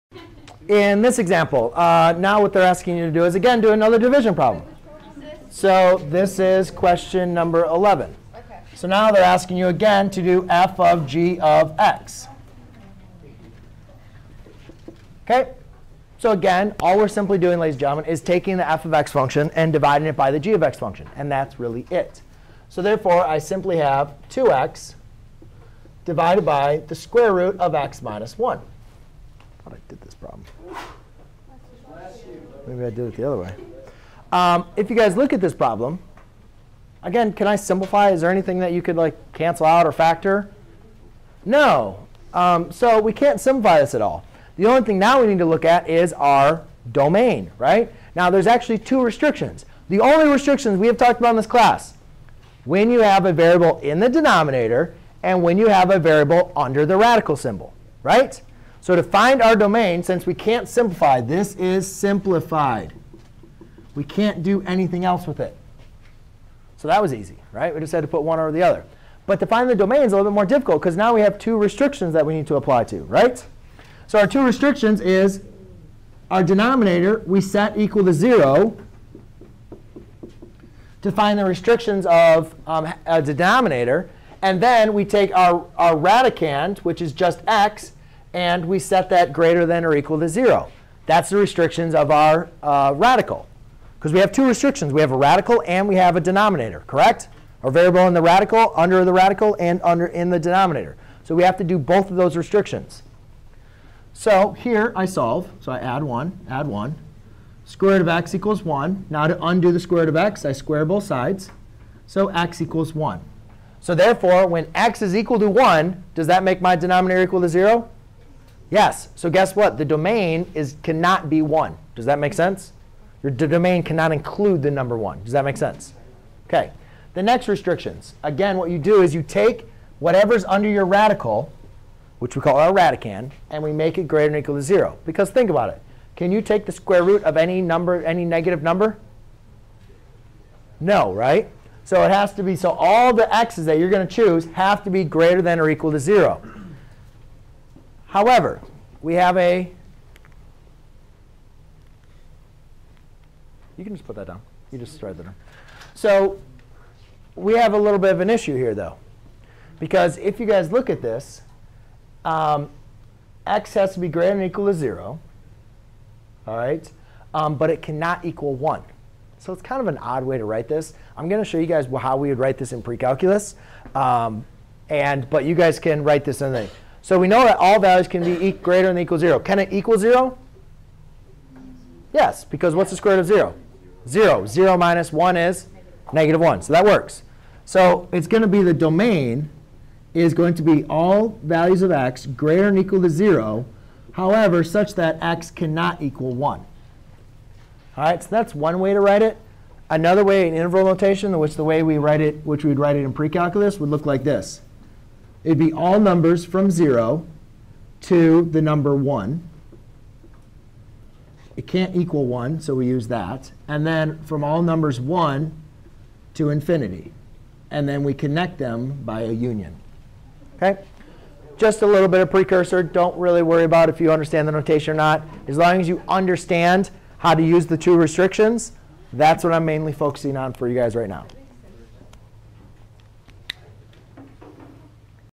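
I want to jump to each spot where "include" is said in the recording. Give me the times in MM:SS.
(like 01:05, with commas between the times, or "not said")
02:04.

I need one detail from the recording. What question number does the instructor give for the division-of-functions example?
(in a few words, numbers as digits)
11.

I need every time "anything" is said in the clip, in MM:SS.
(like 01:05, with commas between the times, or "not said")
00:38, 01:04.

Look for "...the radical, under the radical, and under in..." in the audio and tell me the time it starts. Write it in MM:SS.
01:38.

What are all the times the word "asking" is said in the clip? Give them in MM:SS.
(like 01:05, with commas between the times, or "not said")
00:02, 00:09.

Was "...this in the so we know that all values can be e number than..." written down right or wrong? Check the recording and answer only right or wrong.
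wrong.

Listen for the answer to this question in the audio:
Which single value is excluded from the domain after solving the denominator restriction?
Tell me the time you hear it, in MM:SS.
02:00.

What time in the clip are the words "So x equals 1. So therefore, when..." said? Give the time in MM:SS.
01:52.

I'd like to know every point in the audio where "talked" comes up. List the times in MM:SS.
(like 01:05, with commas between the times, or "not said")
00:50.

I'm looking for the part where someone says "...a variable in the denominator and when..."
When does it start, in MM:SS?
00:53.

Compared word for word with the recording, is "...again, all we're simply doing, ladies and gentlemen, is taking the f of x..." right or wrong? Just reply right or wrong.
right.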